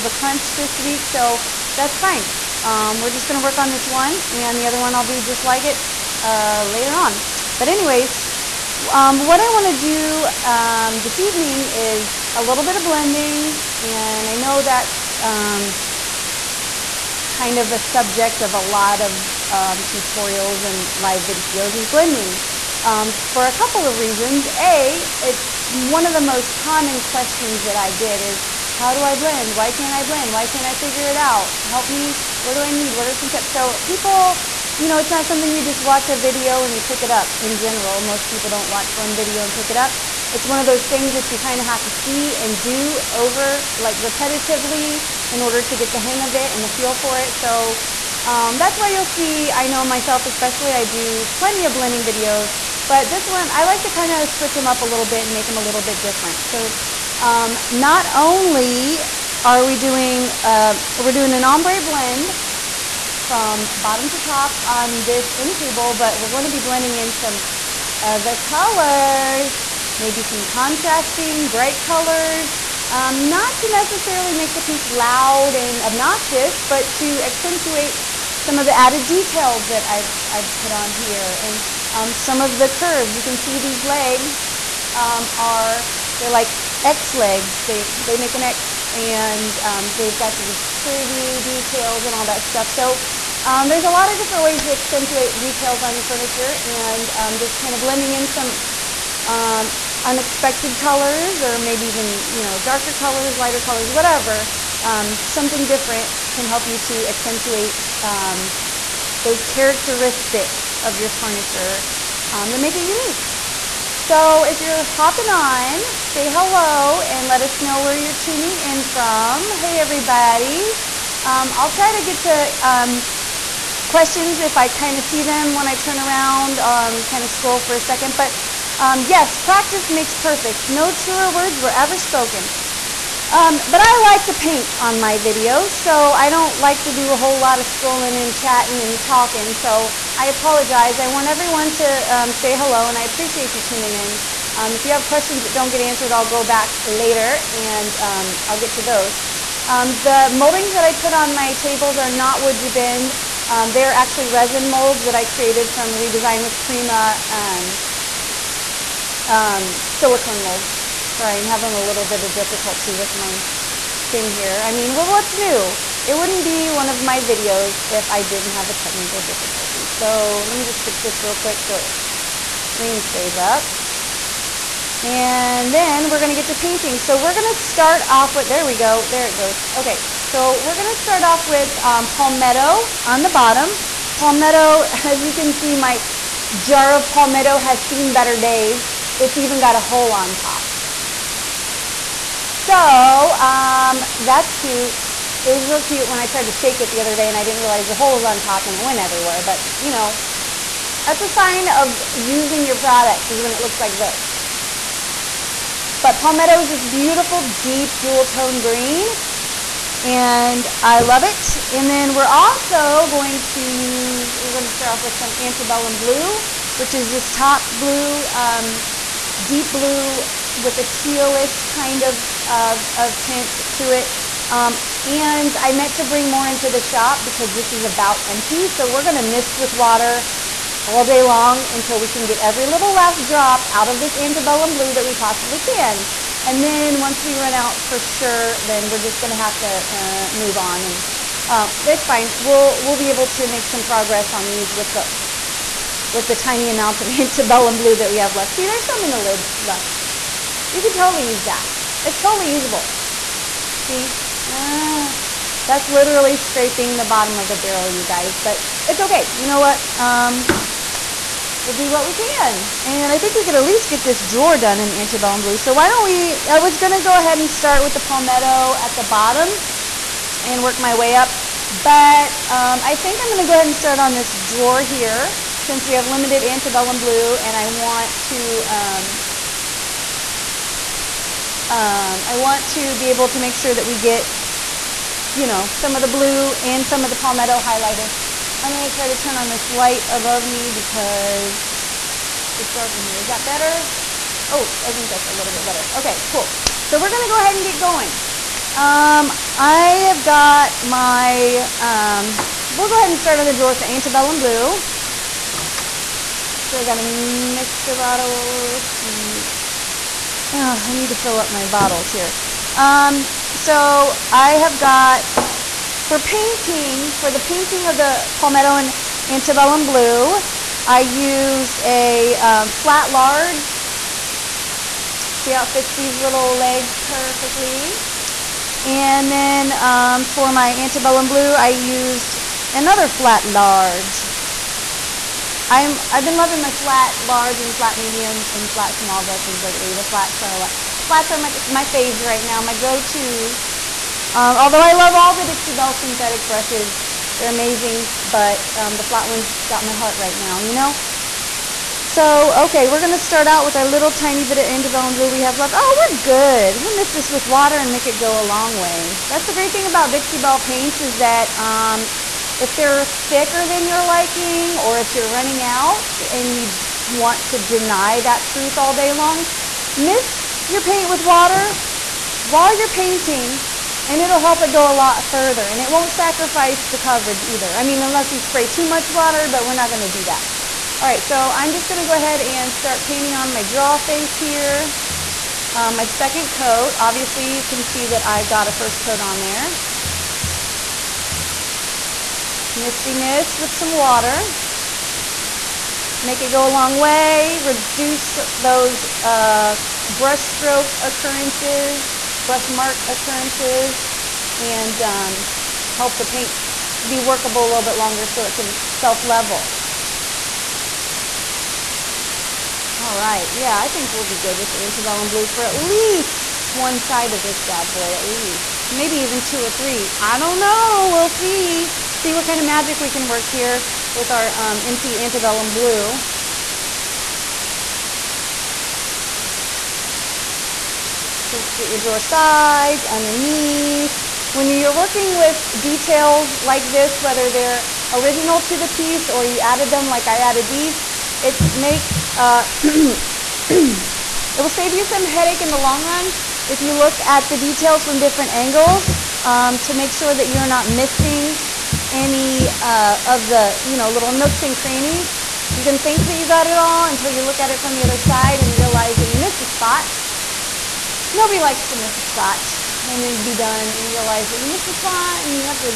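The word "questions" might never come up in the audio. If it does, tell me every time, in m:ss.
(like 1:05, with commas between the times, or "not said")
0:27, 2:03, 2:25.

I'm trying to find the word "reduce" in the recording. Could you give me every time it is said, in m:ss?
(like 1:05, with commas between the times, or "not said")
6:37.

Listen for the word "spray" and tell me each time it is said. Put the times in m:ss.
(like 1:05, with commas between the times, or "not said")
6:18.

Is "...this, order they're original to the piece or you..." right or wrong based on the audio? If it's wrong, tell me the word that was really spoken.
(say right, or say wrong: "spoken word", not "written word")
wrong: "whether", not "order".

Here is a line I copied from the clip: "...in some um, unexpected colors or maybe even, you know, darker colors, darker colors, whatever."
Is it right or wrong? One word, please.
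wrong.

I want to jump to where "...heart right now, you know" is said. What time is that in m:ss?
5:49.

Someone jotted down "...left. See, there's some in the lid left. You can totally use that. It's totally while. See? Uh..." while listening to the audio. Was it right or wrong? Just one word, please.
wrong.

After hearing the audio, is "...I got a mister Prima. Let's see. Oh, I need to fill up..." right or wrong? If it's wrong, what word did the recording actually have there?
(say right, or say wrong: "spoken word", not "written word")
wrong: "Bottle", not "Prima".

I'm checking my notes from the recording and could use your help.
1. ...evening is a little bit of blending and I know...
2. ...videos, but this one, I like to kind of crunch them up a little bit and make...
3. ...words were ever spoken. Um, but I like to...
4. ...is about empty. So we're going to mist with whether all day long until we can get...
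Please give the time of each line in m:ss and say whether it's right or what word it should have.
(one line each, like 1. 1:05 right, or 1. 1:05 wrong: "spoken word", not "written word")
1. 0:11 right
2. 0:52 wrong: "switch", not "crunch"
3. 2:11 right
4. 3:47 wrong: "water", not "whether".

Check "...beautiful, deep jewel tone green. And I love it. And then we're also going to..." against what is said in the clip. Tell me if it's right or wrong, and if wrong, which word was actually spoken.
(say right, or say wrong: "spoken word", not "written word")
right.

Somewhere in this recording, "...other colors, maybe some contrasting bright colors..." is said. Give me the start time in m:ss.
1:08.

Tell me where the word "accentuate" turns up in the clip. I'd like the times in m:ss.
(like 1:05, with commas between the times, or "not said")
1:17, 1:34, 1:47.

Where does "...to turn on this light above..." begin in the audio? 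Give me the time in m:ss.
4:49.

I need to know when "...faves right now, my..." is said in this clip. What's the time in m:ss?
5:41.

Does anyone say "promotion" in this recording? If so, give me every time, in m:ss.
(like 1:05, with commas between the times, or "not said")
not said.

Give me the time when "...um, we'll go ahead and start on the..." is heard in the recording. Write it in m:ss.
5:01.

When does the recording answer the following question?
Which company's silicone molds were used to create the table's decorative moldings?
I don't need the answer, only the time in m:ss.
2:35.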